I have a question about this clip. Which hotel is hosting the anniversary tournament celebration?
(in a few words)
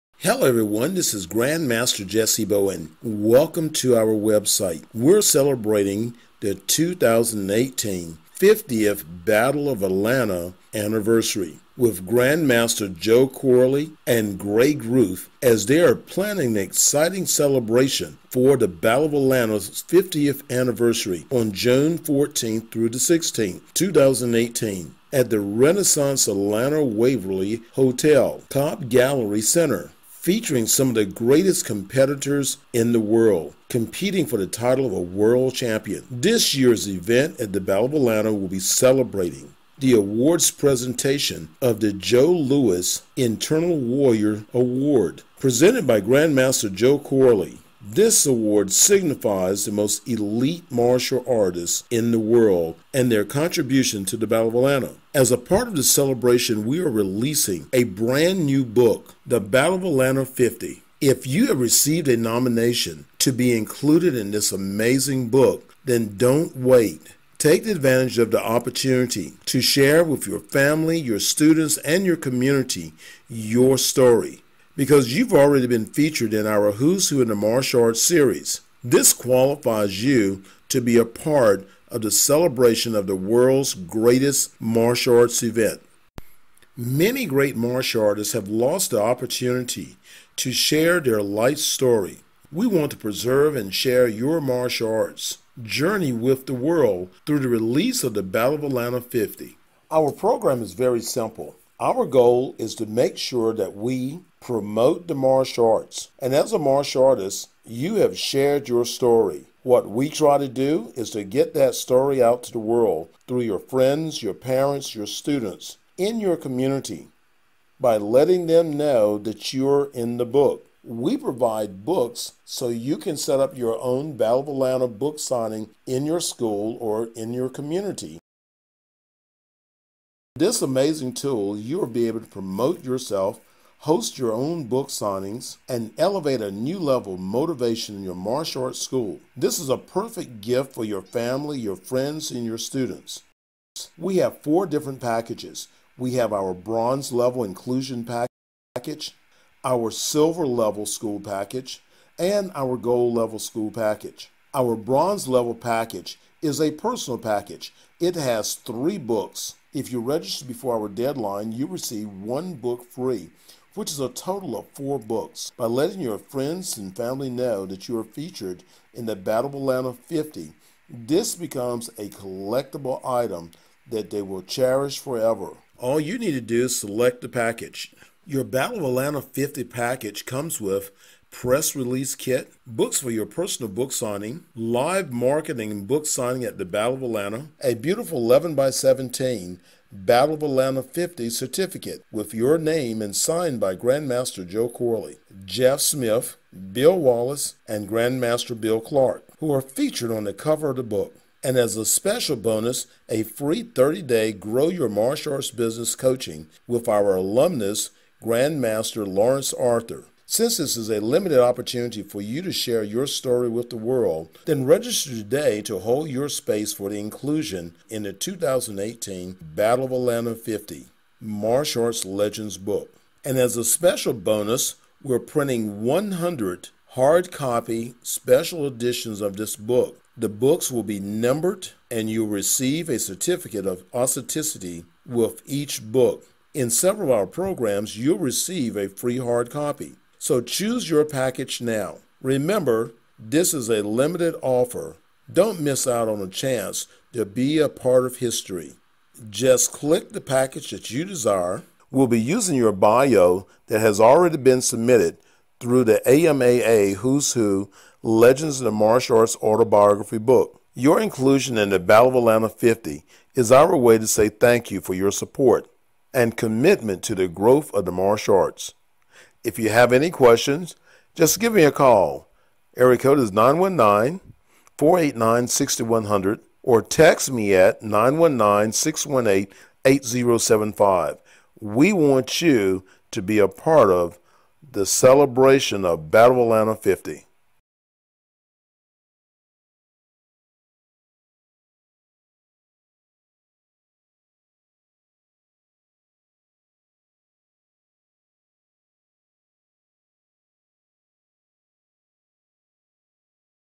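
Renaissance Atlanta Waverly Hotel.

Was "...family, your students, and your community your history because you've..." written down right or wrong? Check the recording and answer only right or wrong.
wrong.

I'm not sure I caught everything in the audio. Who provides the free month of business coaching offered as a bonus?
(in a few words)
Lawrence Arthur.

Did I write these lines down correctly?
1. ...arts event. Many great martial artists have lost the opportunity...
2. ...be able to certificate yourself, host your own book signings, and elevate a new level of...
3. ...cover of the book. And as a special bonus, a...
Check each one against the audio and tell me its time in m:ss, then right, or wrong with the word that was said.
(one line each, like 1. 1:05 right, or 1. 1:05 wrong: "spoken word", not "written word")
1. 1:25 right
2. 2:11 wrong: "promote", not "certificate"
3. 3:20 right.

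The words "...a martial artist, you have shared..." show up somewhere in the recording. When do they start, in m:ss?
1:46.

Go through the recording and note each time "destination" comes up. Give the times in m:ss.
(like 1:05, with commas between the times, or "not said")
not said.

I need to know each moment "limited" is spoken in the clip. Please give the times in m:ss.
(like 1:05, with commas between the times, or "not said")
3:31, 4:03.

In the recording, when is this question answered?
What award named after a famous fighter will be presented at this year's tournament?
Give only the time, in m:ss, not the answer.
0:41.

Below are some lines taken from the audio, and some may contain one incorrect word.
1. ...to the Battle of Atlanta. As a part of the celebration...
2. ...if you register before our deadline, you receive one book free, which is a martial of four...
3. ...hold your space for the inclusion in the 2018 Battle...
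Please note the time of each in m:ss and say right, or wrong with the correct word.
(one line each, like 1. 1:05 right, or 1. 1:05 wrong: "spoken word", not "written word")
1. 0:54 right
2. 2:39 wrong: "total", not "martial"
3. 3:35 right.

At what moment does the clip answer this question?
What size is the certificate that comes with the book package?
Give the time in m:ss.
3:08.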